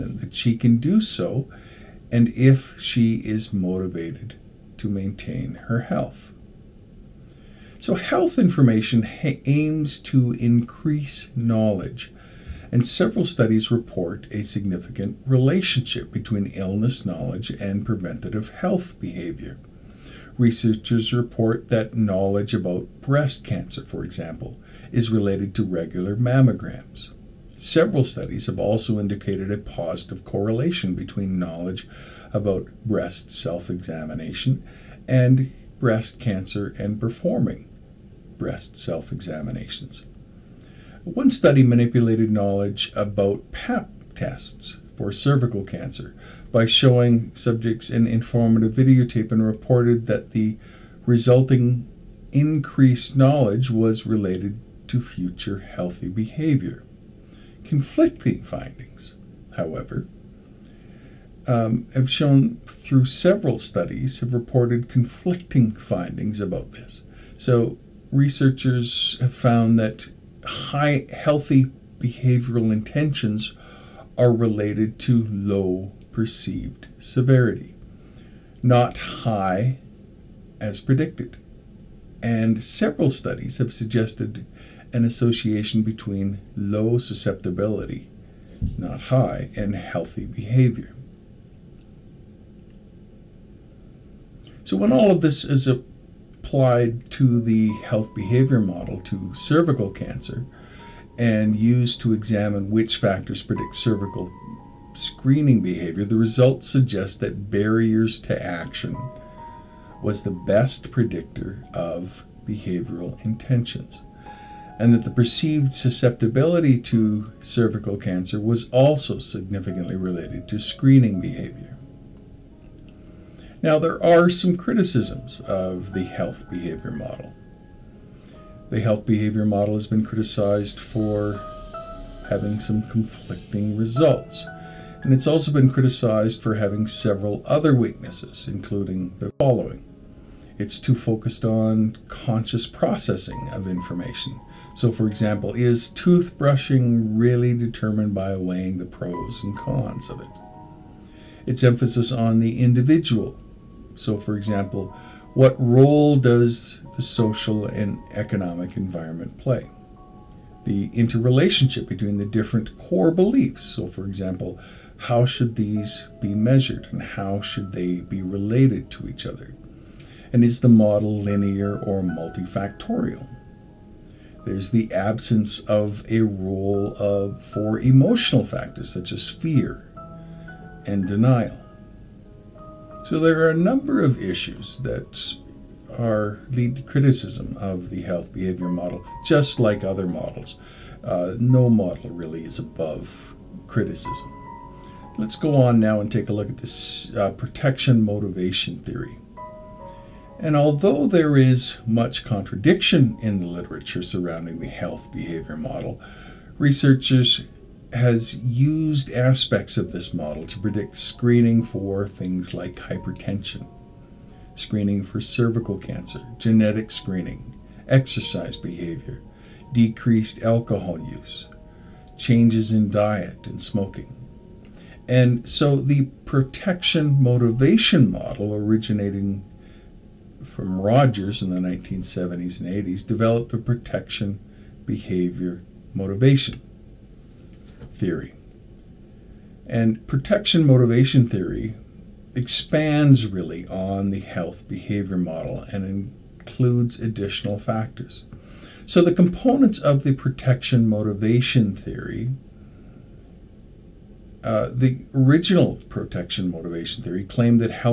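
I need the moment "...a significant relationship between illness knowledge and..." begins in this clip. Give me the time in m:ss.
0:14.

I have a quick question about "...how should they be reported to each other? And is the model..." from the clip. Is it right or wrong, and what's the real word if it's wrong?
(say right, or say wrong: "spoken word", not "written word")
wrong: "related", not "reported".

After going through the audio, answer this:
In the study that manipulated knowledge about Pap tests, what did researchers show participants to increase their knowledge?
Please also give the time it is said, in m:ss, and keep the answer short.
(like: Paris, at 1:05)
An informative videotape, at 0:48.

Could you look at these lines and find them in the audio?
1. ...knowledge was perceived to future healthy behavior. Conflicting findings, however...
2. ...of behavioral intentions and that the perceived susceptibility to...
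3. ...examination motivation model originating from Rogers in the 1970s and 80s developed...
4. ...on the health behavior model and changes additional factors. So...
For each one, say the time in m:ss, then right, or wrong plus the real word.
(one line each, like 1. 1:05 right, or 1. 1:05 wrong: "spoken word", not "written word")
1. 0:53 wrong: "related", not "perceived"
2. 1:51 right
3. 3:46 wrong: "protection", not "examination"
4. 4:03 wrong: "includes", not "changes".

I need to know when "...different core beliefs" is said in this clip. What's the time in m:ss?
2:42.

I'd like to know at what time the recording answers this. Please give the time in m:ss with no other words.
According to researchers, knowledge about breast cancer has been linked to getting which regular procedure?
0:26.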